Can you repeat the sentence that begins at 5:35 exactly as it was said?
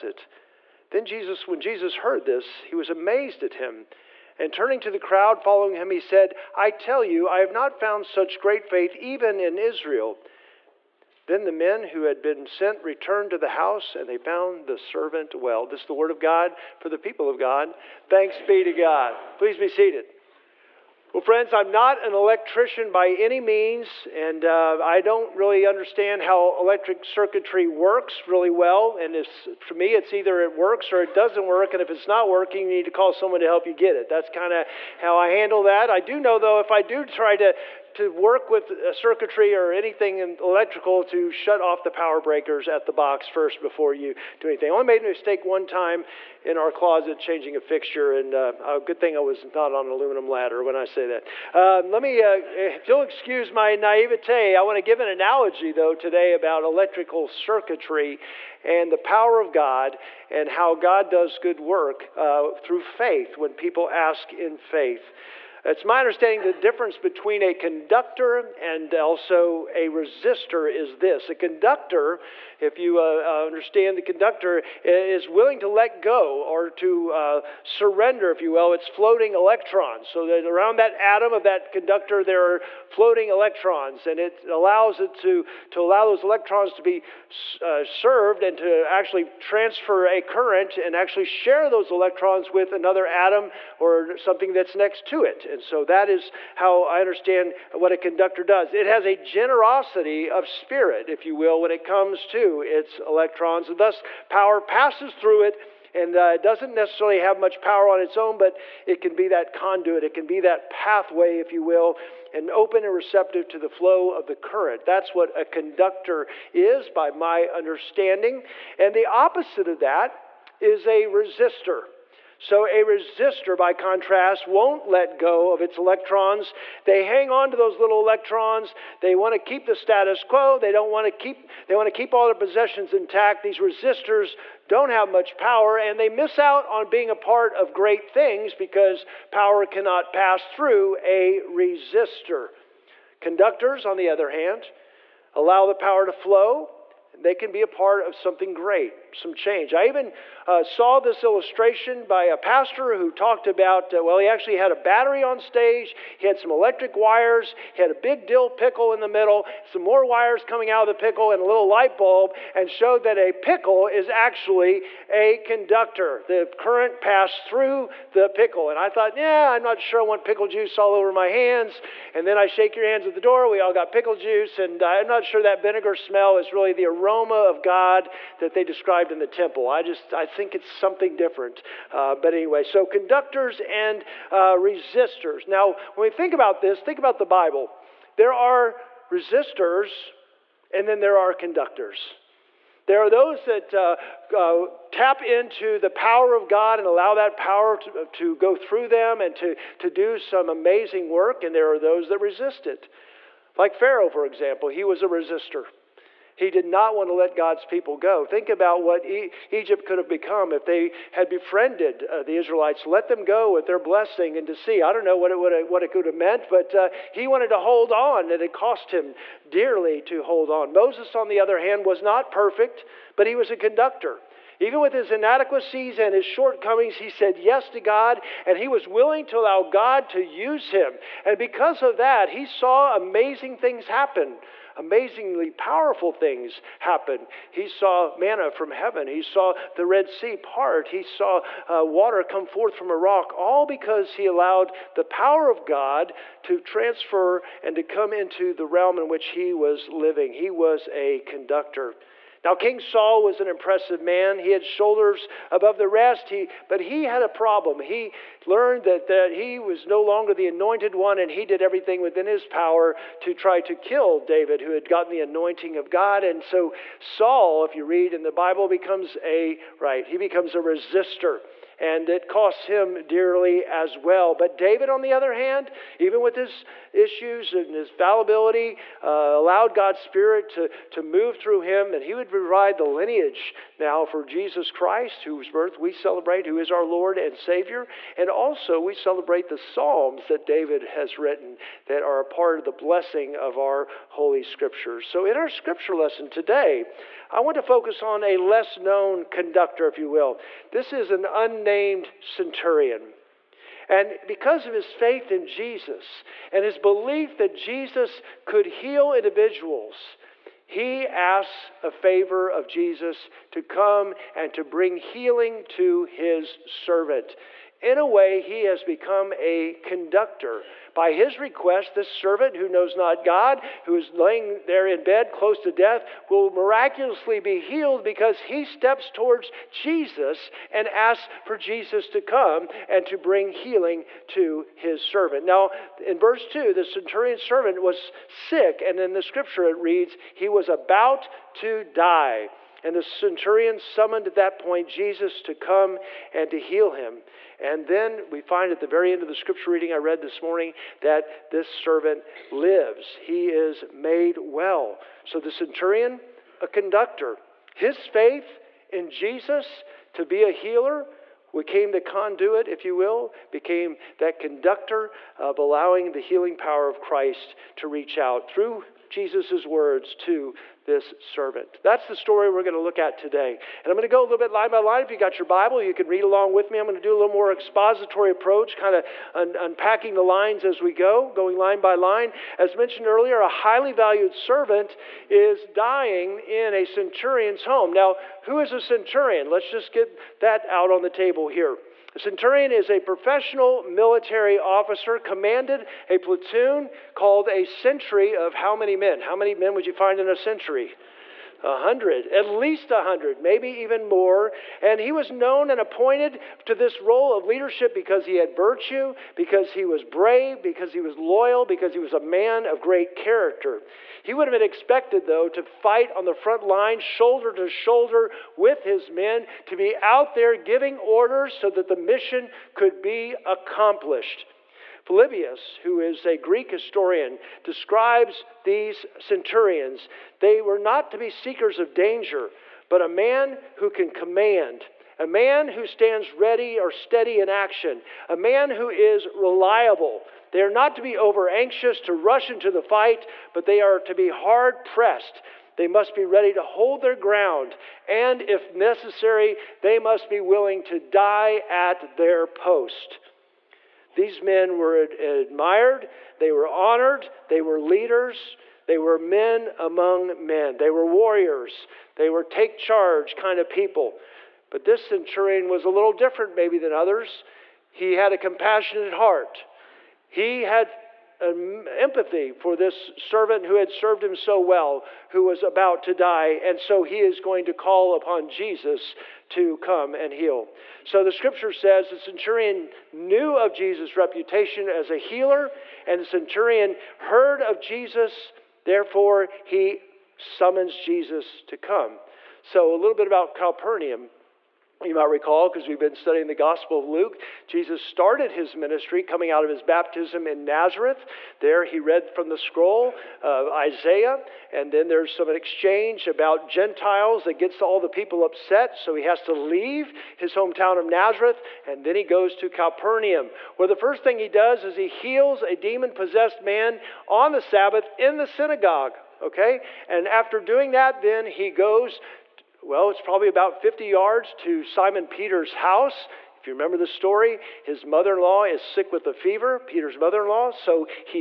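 Now, in verse 2, the centurion servant was sick, and in the scripture it reads, he was about to die.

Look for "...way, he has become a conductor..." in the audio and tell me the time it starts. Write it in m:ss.
5:18.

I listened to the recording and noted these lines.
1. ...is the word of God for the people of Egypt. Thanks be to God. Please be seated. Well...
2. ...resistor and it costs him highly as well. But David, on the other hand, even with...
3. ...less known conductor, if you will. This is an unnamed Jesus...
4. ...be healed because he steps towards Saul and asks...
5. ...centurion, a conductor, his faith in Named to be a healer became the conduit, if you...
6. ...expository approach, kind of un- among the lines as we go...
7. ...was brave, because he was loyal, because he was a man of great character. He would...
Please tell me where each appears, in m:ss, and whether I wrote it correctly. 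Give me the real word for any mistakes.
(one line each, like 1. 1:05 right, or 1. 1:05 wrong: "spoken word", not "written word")
1. 0:15 wrong: "God", not "Egypt"
2. 4:30 wrong: "dearly", not "highly"
3. 4:58 wrong: "Named", not "Jesus"
4. 5:27 wrong: "Jesus", not "Saul"
5. 5:55 wrong: "Jesus", not "Named"
6. 6:17 wrong: "unpacking", not "among"
7. 6:49 right.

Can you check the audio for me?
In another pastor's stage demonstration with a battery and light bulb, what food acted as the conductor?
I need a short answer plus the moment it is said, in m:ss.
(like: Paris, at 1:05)
dill pickle, at 2:38.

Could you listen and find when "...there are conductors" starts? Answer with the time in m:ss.
3:10.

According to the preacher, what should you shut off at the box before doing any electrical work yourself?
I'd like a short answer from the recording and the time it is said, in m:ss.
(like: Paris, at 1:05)
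power breakers, at 0:41.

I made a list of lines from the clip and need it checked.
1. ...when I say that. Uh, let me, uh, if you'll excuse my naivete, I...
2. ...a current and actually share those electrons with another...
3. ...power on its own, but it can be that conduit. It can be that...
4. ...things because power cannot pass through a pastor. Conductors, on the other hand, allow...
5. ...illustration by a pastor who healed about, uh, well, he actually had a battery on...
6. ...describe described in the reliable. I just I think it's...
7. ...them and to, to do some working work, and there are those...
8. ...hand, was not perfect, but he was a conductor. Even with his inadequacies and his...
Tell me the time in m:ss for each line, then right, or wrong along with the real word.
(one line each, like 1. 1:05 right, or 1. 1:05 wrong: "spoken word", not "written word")
1. 0:50 right
2. 1:30 right
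3. 1:47 right
4. 2:18 wrong: "resistor", not "pastor"
5. 2:31 wrong: "talked", not "healed"
6. 2:58 wrong: "temple", not "reliable"
7. 3:18 wrong: "amazing", not "working"
8. 3:41 right.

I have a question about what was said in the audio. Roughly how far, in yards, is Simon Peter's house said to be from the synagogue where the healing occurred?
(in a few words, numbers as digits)
50 yards.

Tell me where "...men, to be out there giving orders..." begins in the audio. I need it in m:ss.
6:59.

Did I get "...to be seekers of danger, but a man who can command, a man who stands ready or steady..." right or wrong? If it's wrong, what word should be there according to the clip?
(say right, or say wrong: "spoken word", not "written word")
right.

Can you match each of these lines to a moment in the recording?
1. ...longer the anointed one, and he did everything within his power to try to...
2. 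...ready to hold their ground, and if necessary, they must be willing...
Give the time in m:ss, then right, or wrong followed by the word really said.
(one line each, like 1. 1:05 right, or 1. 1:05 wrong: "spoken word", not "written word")
1. 4:20 right
2. 7:26 right.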